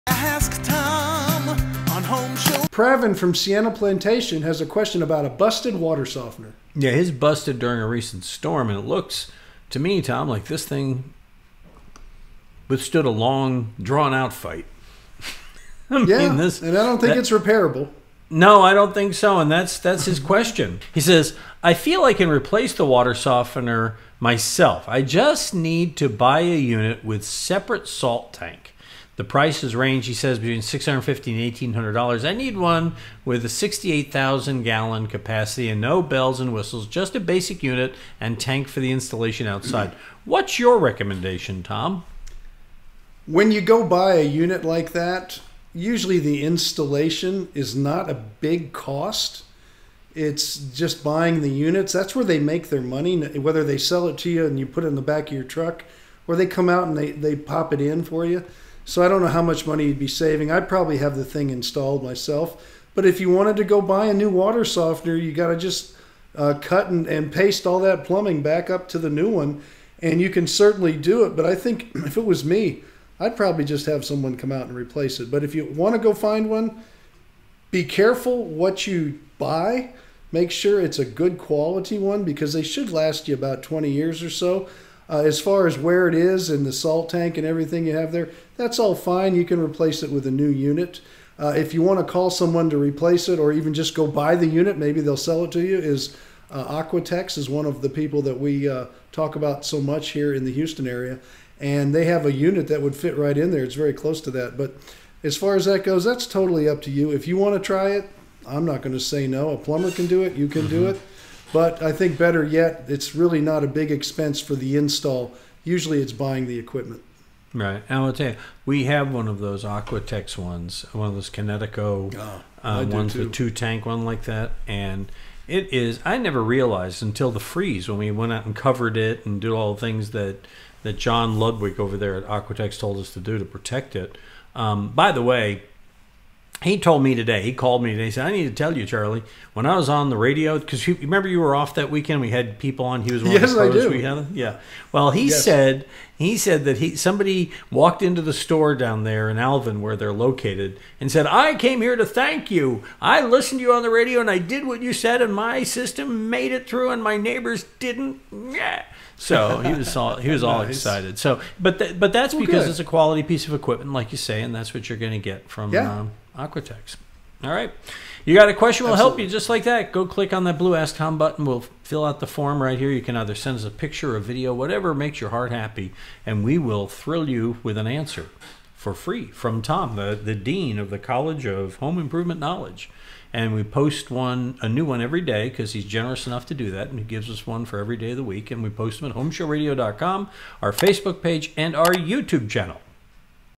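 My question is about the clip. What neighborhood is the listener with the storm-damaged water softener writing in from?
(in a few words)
Sienna Plantation.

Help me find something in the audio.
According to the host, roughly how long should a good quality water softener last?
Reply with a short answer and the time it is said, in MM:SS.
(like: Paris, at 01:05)
20 years, at 01:23.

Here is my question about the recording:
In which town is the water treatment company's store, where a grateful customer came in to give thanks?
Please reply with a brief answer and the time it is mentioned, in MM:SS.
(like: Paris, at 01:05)
Alvin, at 02:29.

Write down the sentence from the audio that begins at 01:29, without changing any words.
You can replace it with a new unit.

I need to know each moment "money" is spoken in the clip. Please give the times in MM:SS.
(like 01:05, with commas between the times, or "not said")
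00:52, 00:59.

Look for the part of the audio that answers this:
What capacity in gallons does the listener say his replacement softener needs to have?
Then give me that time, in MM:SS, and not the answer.
00:33.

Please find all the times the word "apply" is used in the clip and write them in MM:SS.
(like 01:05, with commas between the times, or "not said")
not said.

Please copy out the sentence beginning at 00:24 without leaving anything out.
I just need to buy a unit with separate salt tank.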